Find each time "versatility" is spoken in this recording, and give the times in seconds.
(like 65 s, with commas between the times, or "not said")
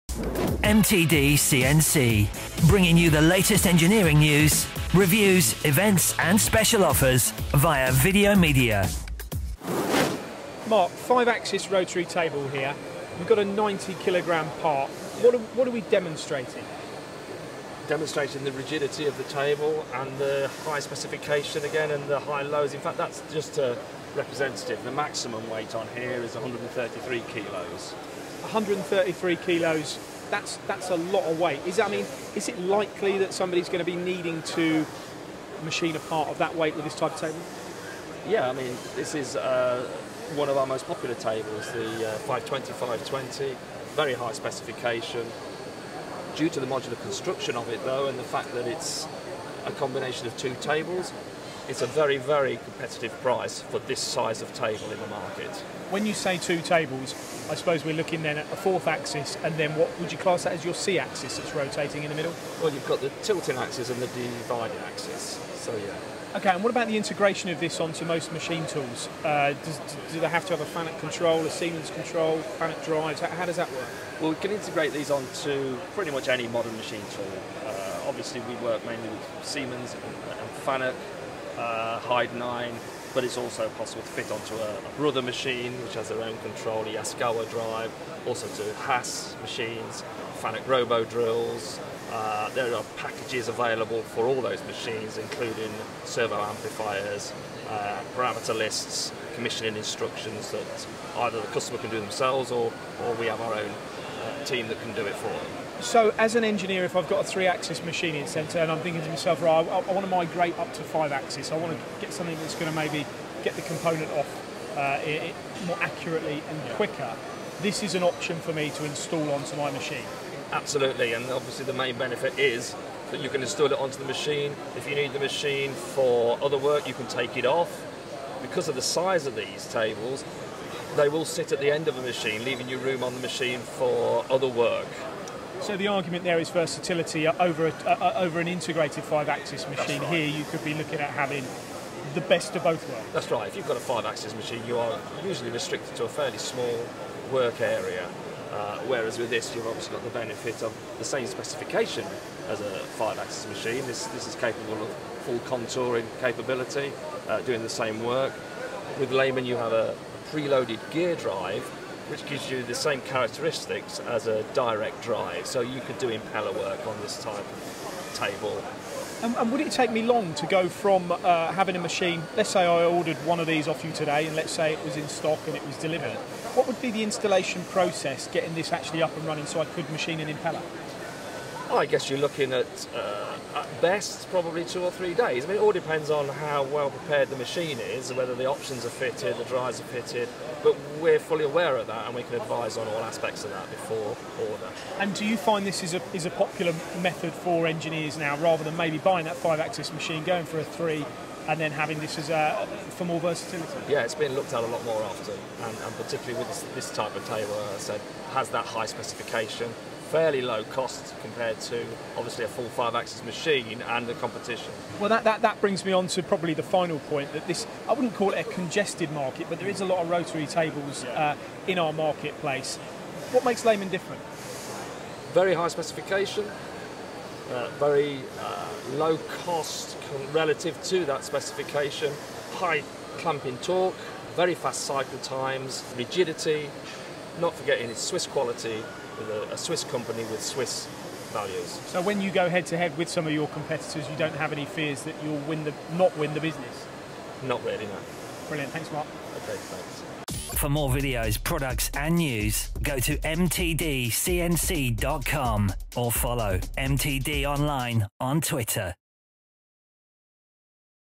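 136 s, 203 s.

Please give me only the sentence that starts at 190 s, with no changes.
But we're fully aware of that, and we can advise on all aspects of that before order.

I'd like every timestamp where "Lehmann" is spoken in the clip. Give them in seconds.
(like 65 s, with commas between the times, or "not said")
159 s, 223 s.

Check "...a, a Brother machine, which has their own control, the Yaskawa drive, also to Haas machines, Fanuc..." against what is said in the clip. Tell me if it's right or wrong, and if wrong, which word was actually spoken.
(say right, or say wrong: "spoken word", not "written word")
right.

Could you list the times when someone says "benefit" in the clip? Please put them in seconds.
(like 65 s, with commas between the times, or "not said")
121 s, 150 s.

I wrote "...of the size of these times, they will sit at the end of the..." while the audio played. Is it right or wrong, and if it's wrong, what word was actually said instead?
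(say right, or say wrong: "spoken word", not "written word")
wrong: "tables", not "times".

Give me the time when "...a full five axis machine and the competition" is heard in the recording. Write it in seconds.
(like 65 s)
212 s.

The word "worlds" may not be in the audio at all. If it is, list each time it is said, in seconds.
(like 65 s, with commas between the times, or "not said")
142 s.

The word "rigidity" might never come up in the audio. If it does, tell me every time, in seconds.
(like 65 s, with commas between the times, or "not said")
18 s, 235 s.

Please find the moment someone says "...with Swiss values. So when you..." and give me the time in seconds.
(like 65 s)
240 s.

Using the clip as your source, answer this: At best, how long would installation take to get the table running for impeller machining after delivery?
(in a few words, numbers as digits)
2 or 3 days.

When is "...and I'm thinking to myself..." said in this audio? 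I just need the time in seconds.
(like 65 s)
108 s.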